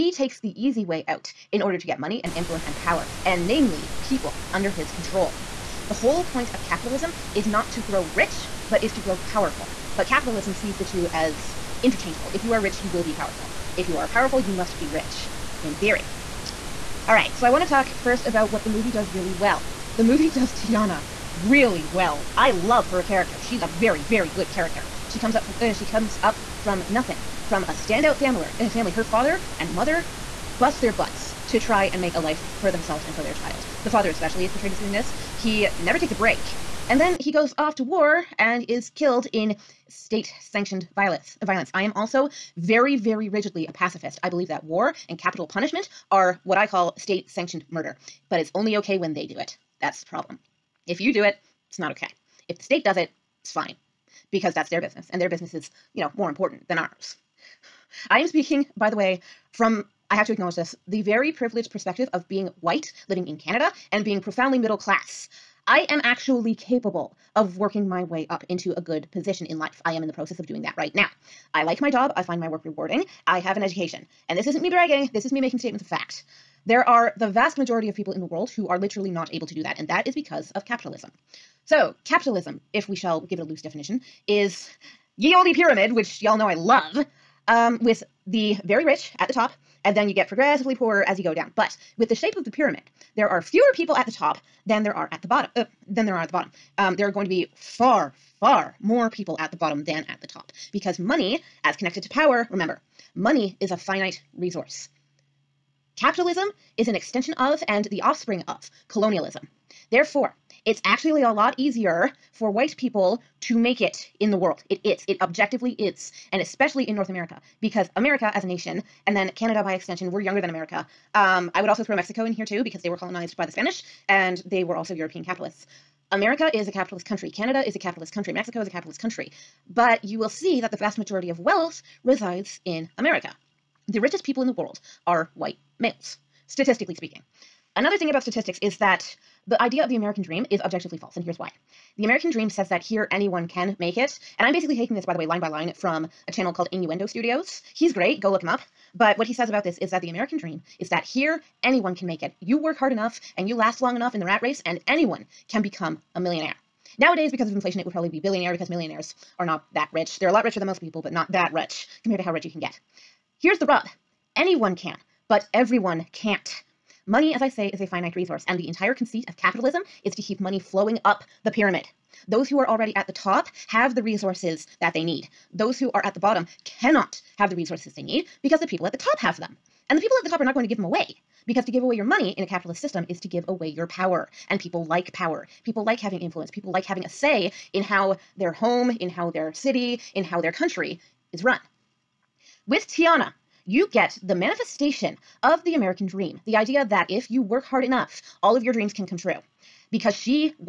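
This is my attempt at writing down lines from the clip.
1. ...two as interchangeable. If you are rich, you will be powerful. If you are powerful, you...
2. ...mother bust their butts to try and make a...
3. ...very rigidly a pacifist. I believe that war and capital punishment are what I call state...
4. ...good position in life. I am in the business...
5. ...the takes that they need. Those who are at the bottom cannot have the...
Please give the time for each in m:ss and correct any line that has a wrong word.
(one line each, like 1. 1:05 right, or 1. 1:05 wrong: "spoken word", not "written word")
1. 0:10 right
2. 0:29 right
3. 0:42 right
4. 1:08 wrong: "process", not "business"
5. 2:53 wrong: "resources", not "takes".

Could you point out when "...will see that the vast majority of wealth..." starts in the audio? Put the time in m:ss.
2:10.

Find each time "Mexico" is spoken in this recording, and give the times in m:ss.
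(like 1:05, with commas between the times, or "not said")
2:01, 2:08.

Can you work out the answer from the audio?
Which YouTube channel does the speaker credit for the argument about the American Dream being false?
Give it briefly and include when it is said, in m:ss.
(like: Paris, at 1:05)
Innuendo Studios, at 2:26.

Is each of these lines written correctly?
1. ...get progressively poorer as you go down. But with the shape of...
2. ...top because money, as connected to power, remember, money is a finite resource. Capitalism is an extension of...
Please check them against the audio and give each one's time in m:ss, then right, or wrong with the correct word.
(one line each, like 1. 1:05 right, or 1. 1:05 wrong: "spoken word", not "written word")
1. 1:30 right
2. 1:40 right.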